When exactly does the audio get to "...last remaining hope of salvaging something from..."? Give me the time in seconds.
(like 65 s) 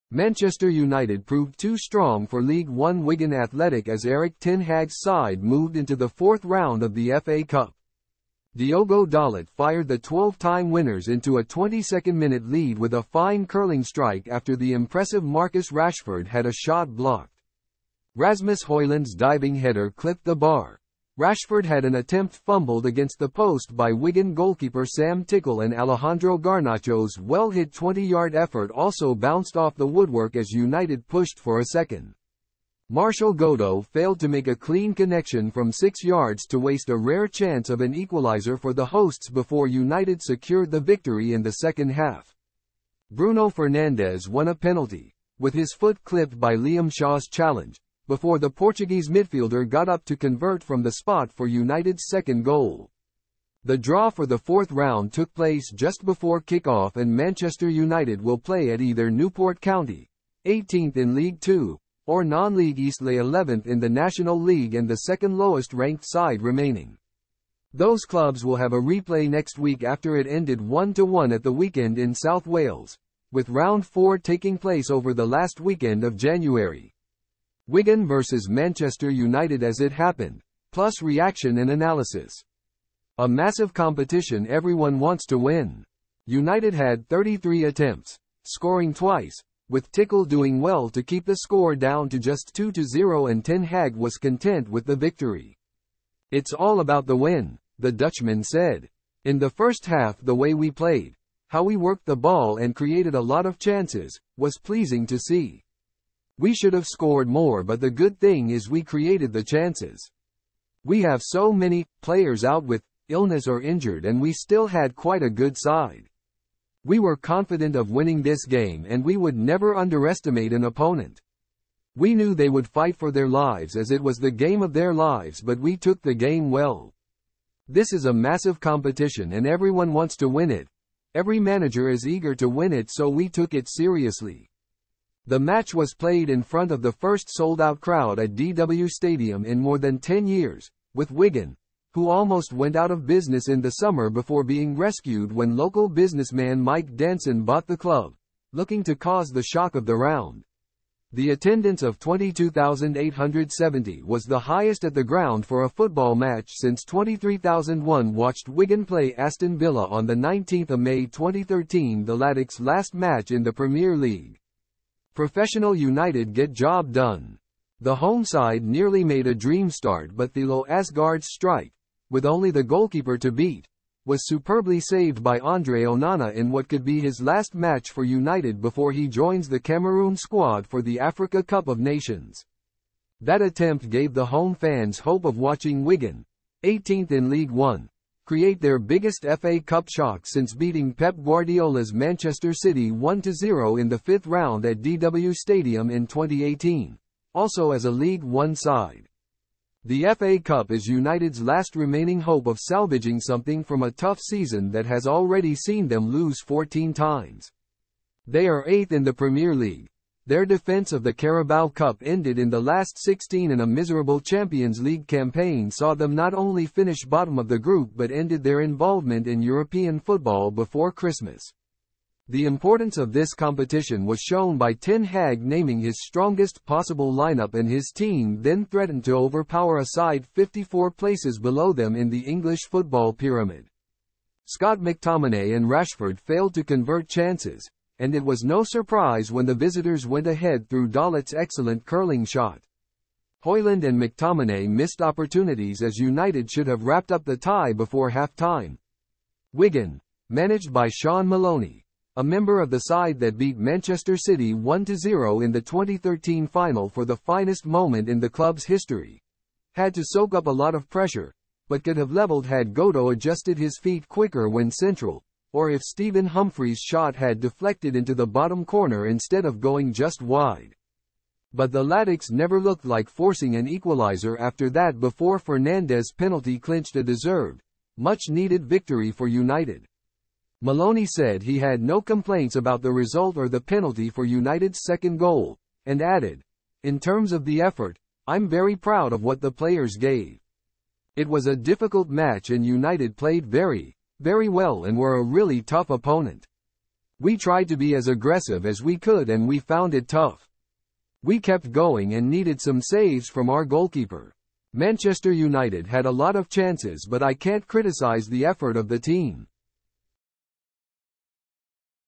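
201 s.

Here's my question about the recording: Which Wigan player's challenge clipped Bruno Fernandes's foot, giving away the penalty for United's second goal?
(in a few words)
Liam Shaw.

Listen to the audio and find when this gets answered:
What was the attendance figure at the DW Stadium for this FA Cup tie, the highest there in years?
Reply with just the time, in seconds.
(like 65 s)
151 s.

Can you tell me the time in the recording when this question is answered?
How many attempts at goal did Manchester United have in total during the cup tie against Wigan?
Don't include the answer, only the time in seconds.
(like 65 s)
87 s.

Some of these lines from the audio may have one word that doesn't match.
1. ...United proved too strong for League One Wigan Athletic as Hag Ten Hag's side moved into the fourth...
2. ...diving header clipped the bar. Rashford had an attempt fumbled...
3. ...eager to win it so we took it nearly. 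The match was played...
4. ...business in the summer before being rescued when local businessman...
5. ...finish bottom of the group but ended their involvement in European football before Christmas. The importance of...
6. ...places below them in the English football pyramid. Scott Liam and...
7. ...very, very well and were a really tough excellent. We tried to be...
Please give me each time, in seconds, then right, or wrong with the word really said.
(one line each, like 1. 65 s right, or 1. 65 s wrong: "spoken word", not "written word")
1. 0 s wrong: "Erik", not "Hag"
2. 19 s right
3. 132 s wrong: "seriously", not "nearly"
4. 143 s right
5. 216 s right
6. 230 s wrong: "McTominay", not "Liam"
7. 293 s wrong: "opponent", not "excellent".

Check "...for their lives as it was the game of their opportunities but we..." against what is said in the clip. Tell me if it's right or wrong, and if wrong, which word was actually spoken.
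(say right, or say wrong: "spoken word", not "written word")
wrong: "lives", not "opportunities".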